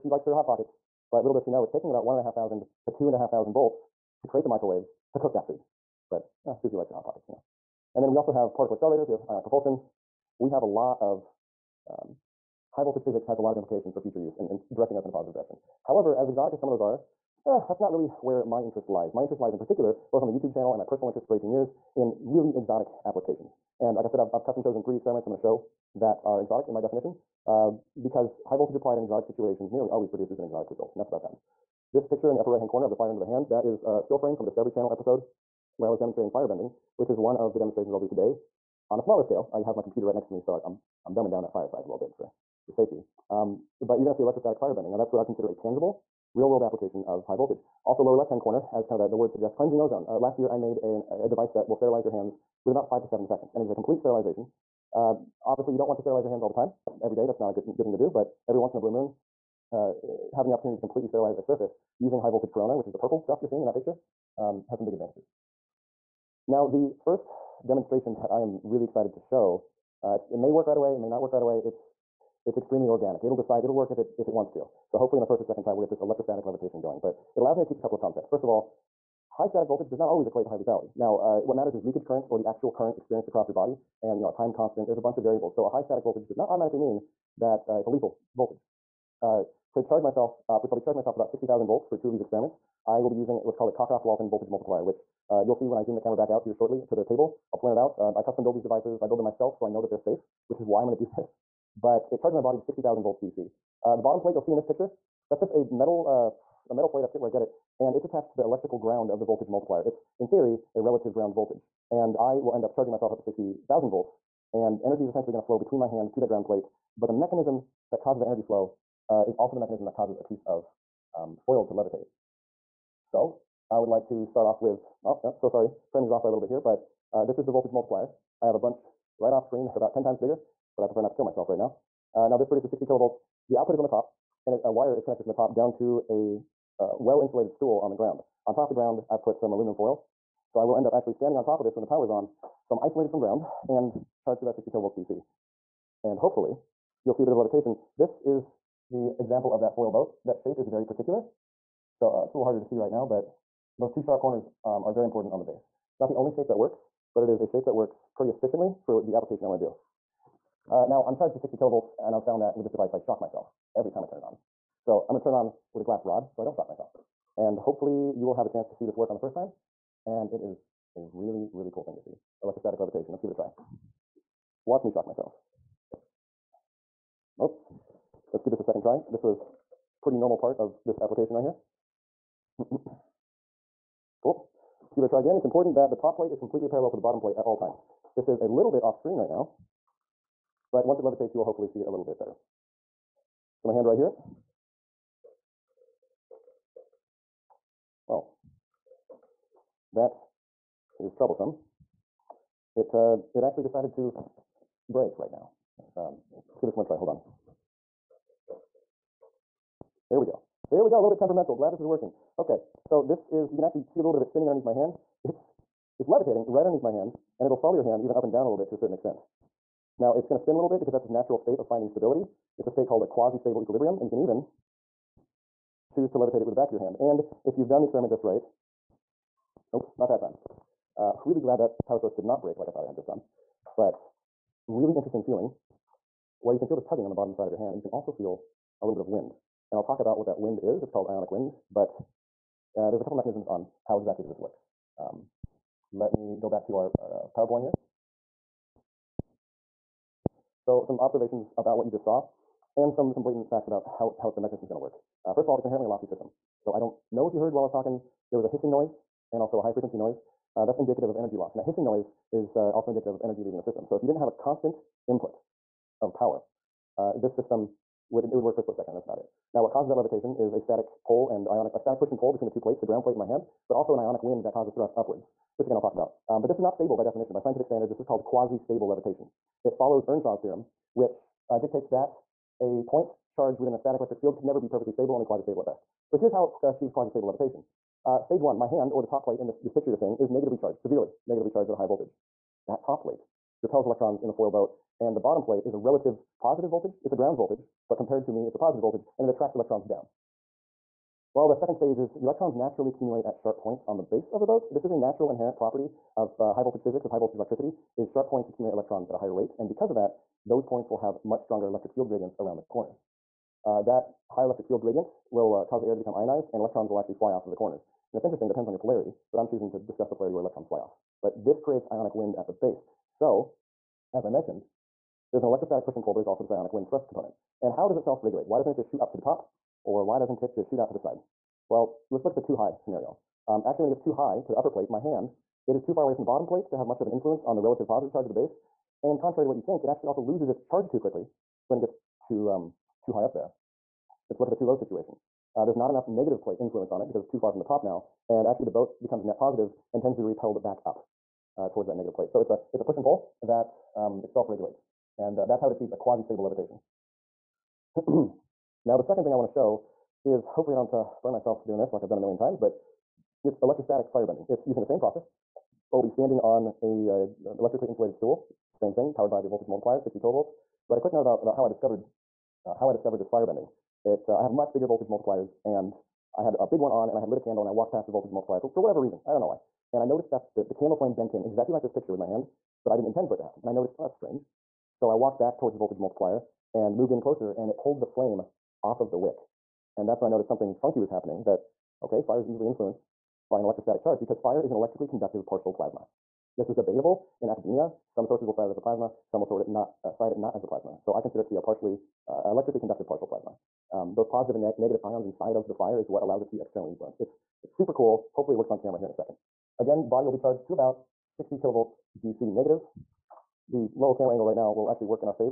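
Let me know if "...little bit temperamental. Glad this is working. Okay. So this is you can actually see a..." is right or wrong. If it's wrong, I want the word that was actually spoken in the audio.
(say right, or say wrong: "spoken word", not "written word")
right.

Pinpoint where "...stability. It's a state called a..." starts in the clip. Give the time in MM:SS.
03:41.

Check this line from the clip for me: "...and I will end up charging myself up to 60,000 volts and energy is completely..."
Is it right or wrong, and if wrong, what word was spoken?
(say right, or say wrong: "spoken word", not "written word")
wrong: "essentially", not "completely".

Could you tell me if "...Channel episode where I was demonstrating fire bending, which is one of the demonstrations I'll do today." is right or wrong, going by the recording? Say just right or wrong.
right.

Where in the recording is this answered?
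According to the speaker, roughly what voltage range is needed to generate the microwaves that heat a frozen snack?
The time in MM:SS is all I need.
00:02.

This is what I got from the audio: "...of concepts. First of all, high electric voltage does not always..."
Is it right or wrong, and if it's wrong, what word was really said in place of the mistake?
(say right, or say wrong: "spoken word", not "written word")
wrong: "static", not "electric".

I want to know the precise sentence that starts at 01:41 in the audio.
But it charges my body to 60,000 volts DC.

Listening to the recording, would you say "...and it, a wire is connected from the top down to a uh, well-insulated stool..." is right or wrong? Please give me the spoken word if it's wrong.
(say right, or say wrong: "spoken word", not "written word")
right.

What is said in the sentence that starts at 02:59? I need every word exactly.
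This was pretty normal part of this application right here.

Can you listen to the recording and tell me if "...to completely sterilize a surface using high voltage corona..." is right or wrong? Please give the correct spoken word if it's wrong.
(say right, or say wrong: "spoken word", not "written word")
right.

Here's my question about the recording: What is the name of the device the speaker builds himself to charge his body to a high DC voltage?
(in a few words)
Cockcroft-Walton voltage multiplier.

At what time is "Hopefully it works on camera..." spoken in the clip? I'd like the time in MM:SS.
06:48.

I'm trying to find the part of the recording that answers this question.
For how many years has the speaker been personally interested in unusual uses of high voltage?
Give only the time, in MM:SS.
00:21.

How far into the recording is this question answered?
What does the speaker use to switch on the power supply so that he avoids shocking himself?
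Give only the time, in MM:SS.
02:45.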